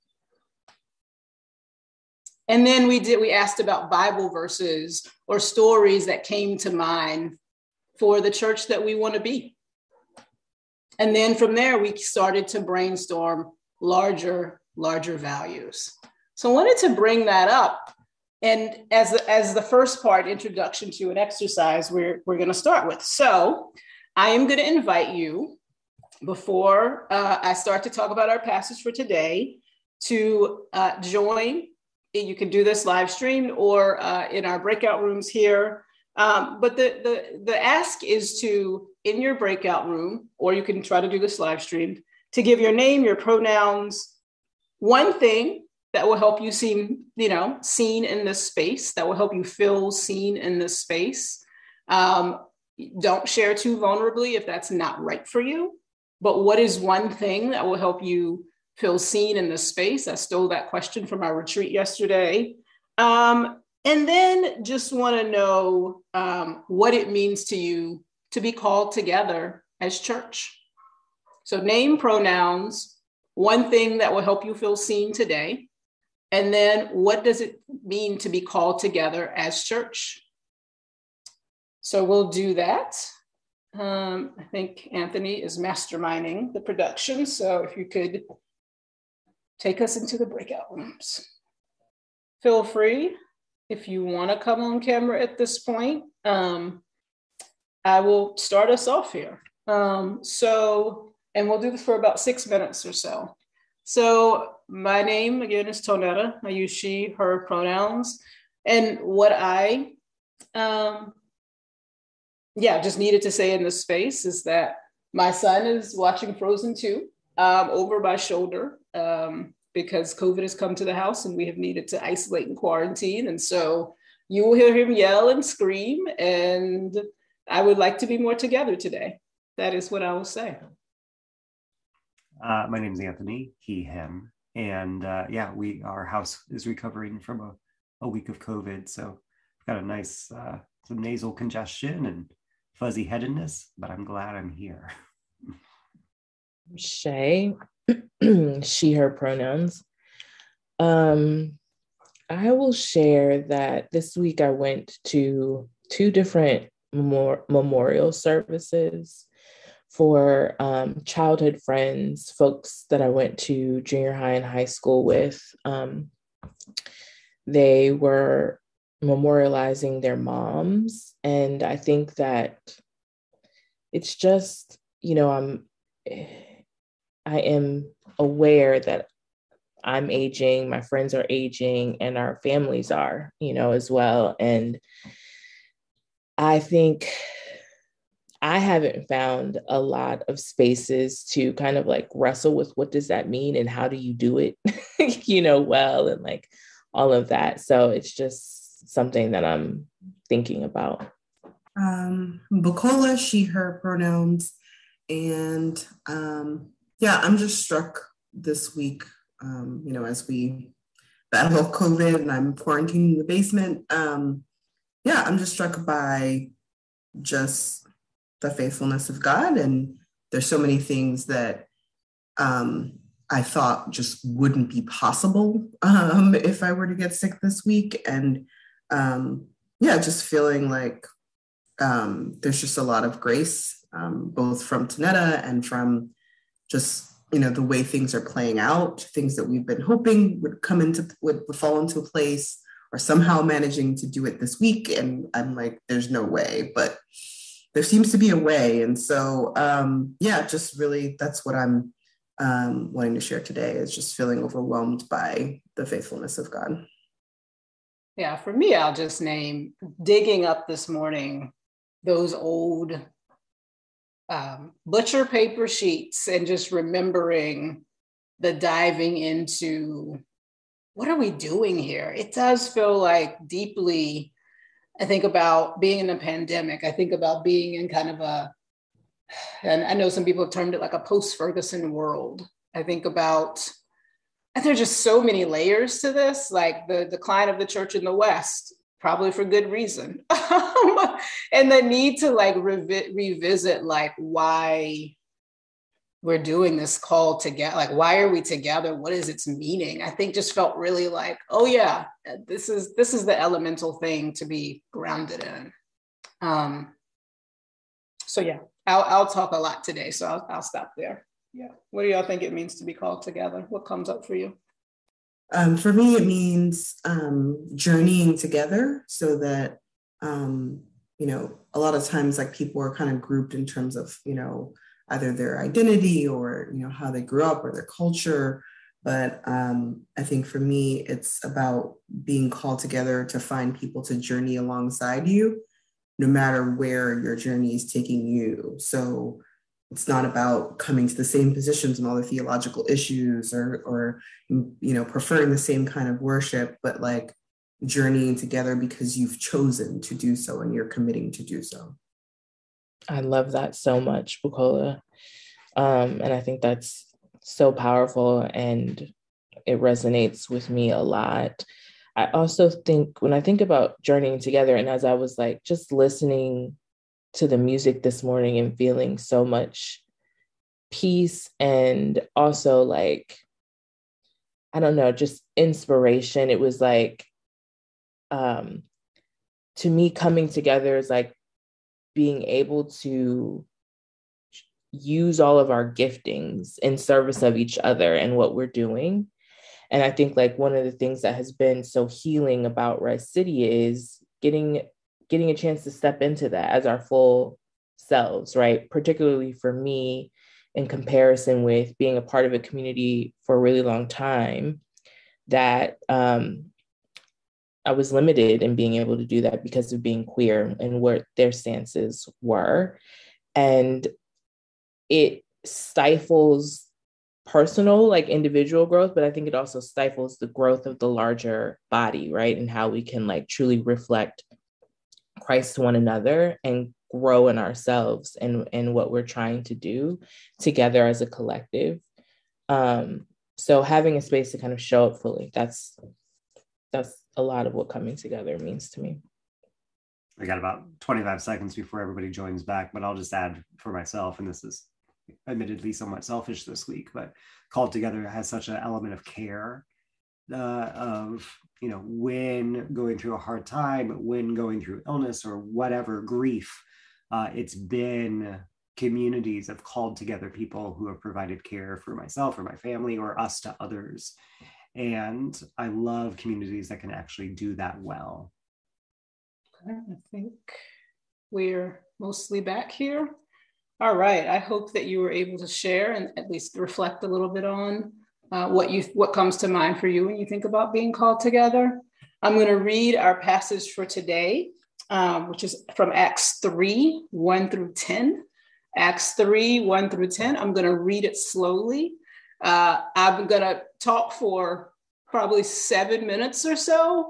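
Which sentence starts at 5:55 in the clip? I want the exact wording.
Um, and I think that's so powerful and it resonates with me a lot.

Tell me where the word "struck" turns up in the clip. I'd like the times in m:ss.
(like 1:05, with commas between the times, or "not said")
3:27, 3:35.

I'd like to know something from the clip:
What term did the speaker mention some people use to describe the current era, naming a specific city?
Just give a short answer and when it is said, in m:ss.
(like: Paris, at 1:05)
Post Ferguson world, at 4:40.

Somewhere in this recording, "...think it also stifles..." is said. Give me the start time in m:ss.
6:59.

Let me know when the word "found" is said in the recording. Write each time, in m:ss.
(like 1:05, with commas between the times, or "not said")
3:09.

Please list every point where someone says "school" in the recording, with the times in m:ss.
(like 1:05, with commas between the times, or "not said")
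2:44.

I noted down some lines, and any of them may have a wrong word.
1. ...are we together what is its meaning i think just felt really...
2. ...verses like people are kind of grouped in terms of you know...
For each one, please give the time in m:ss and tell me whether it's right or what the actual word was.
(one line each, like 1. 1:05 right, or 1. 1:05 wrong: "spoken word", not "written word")
1. 4:58 right
2. 5:22 wrong: "times", not "verses".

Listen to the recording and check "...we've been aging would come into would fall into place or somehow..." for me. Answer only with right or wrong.
wrong.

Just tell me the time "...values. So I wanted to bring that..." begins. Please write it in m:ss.
0:15.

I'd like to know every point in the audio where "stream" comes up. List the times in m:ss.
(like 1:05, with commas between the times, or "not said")
0:33, 0:41.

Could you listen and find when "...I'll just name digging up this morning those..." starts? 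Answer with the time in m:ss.
4:18.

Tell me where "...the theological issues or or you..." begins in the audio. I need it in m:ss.
5:42.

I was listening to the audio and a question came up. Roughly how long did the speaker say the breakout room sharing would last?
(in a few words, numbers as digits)
6 minutes.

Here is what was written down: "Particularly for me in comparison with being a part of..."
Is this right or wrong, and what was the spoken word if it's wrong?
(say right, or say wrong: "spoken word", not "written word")
right.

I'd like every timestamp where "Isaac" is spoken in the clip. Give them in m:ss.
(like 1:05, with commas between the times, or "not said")
not said.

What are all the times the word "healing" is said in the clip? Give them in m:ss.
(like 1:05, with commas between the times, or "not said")
6:32.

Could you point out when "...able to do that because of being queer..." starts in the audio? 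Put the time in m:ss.
6:48.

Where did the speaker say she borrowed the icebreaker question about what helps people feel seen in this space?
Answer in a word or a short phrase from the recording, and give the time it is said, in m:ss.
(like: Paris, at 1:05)
Retreat, at 1:01.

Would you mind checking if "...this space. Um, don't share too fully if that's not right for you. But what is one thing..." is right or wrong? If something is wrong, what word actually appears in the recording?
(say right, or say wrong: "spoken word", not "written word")
wrong: "vulnerably", not "fully".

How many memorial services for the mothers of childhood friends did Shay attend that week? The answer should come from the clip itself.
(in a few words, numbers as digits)
2.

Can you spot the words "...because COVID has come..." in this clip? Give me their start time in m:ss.
1:59.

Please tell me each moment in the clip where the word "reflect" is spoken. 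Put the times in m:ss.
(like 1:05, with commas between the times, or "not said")
7:03, 7:56.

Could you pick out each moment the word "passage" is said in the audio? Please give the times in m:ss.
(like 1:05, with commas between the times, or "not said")
0:28, 8:03.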